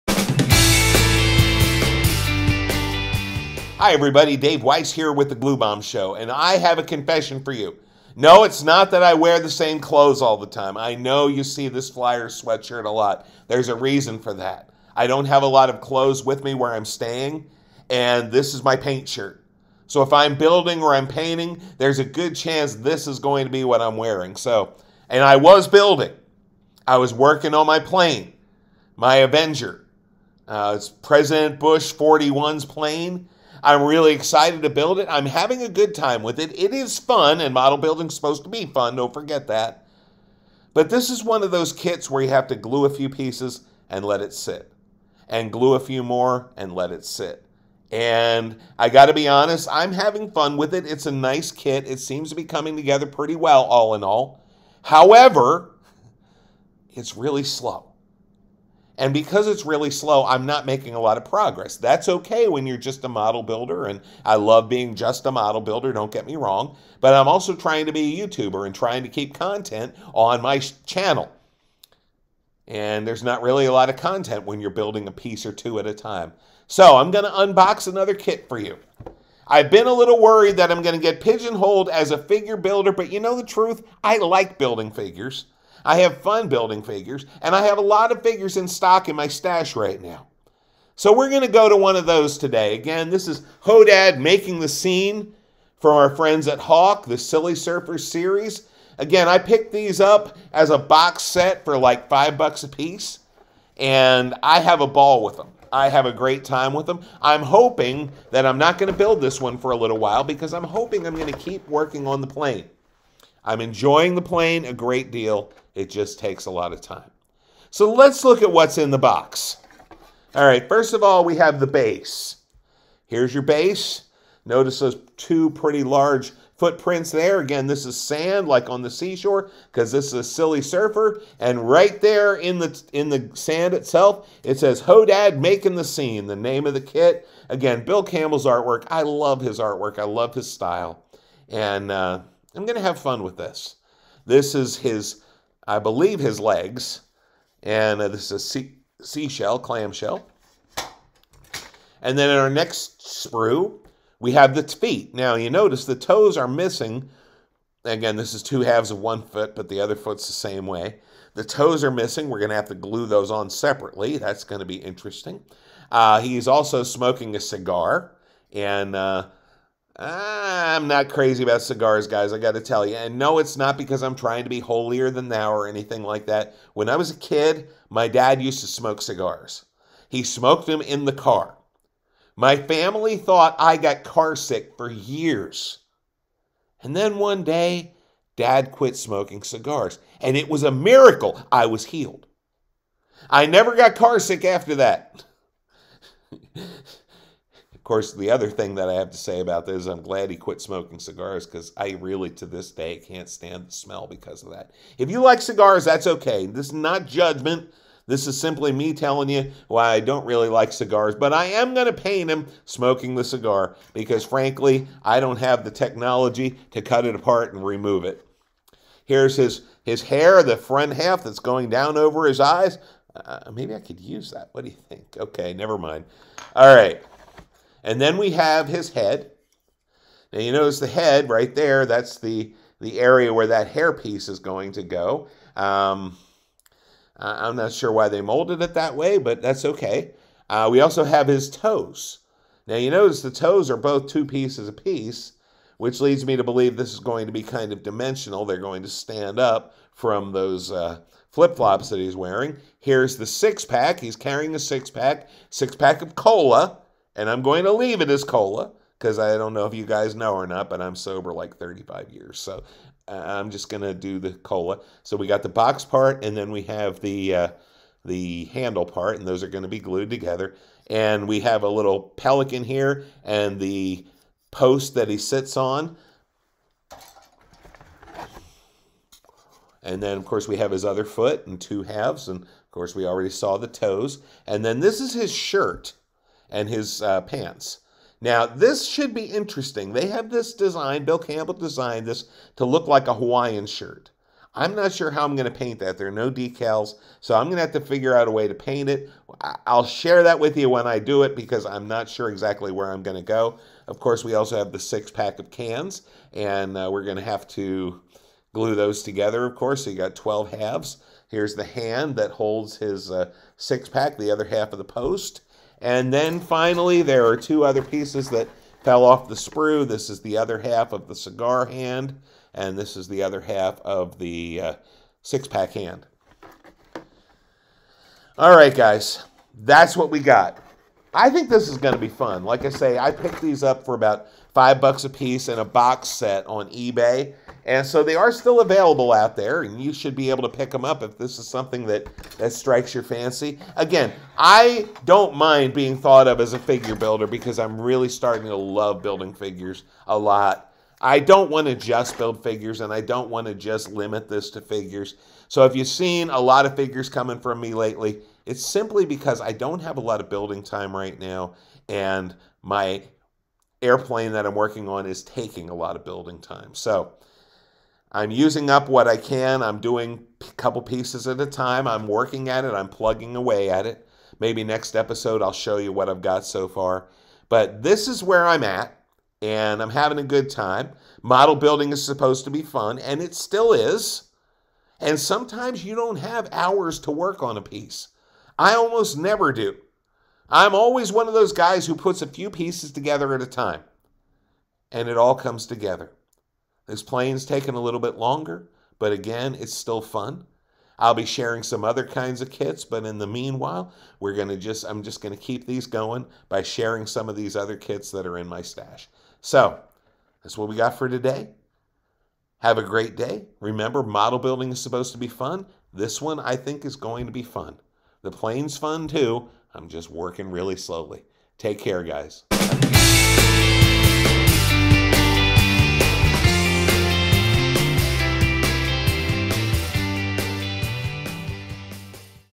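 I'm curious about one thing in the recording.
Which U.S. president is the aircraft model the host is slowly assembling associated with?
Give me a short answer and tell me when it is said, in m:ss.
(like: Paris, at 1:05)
Bush 41, at 0:30.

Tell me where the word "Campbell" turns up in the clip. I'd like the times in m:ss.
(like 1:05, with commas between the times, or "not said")
2:18, 4:51.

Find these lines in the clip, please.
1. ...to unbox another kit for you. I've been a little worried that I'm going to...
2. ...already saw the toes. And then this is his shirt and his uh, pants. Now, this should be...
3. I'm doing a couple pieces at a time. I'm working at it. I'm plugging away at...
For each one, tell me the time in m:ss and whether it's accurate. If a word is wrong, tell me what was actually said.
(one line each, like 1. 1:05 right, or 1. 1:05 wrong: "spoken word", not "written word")
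1. 1:17 right
2. 4:43 right
3. 6:09 right.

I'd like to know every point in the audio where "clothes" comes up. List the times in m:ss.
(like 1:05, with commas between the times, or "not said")
0:09, 0:15.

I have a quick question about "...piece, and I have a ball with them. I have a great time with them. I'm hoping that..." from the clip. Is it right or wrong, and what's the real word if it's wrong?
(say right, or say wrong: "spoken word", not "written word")
right.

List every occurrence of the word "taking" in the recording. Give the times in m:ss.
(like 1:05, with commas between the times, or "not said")
6:05, 6:37.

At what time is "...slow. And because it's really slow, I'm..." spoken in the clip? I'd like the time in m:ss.
0:57.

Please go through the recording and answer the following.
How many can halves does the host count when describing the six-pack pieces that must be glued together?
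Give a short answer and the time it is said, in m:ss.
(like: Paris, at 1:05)
12, at 5:10.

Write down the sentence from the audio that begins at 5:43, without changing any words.
Again, I don't mind being thought of as a figure builder because I'm really starting to love building figures a lot.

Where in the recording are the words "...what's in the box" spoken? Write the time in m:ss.
1:58.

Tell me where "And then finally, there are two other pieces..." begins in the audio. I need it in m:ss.
5:15.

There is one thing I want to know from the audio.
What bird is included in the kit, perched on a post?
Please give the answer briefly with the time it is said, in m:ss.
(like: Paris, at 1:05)
pelican, at 4:32.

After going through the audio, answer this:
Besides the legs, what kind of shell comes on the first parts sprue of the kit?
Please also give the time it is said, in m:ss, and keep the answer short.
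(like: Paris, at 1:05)
clamshell, at 2:29.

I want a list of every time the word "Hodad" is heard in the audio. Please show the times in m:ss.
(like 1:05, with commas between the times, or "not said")
1:33, 2:14.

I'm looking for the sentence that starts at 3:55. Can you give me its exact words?
Um, I'm not sure why they molded it that way, but that's okay.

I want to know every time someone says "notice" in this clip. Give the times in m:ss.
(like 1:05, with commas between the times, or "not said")
2:04, 2:35, 3:50, 4:02.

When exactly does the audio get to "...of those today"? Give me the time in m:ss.
1:31.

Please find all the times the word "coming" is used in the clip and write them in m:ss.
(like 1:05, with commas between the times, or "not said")
0:52, 5:57.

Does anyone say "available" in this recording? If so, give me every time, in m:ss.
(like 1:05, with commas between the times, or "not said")
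5:38.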